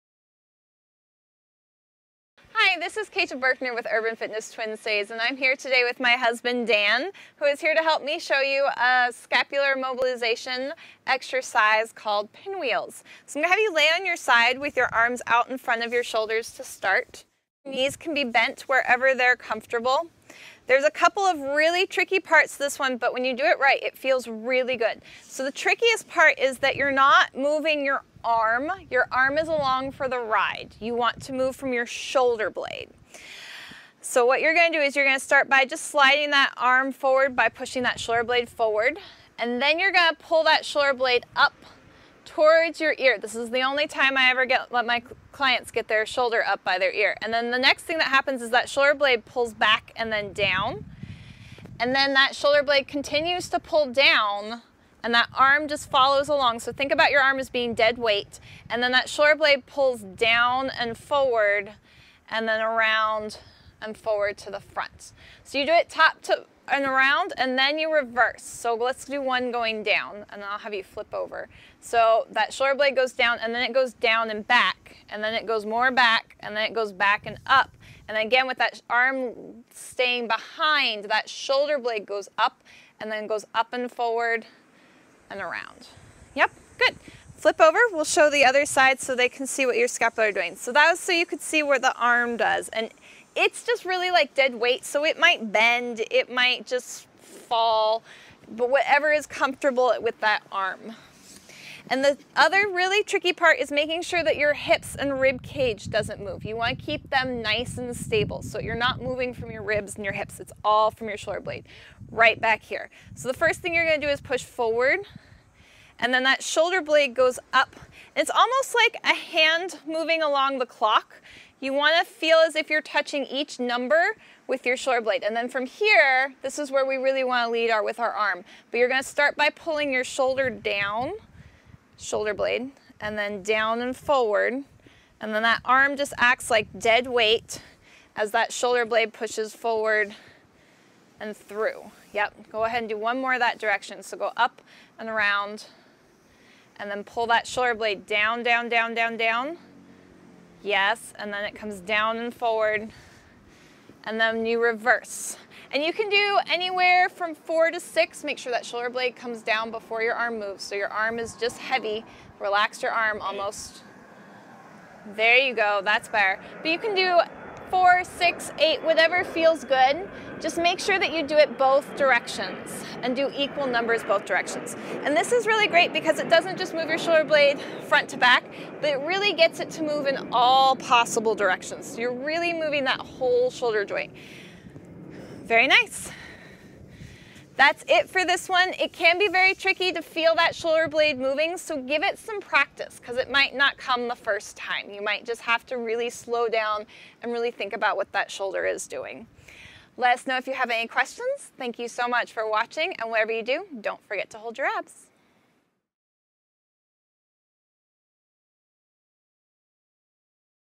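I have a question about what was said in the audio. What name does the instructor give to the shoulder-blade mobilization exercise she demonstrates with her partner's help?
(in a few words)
Pinwheels.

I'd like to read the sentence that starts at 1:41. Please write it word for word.
And the other really tricky part is making sure that your hips and rib cage doesn't move.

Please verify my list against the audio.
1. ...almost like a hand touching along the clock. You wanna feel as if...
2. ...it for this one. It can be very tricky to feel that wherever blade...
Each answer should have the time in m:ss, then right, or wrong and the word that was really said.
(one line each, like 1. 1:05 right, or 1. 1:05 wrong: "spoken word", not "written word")
1. 1:58 wrong: "moving", not "touching"
2. 3:07 wrong: "shoulder", not "wherever".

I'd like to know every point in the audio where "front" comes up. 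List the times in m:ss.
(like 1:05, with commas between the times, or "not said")
0:15, 1:04, 2:57.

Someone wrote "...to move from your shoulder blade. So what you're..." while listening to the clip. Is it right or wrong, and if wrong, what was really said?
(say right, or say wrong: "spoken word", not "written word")
right.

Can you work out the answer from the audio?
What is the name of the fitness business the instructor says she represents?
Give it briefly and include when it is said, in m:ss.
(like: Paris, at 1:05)
Urban Fitness Twin Cities, at 0:03.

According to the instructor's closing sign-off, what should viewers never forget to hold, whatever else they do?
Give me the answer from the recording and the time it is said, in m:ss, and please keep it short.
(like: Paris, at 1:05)
Your abs, at 3:24.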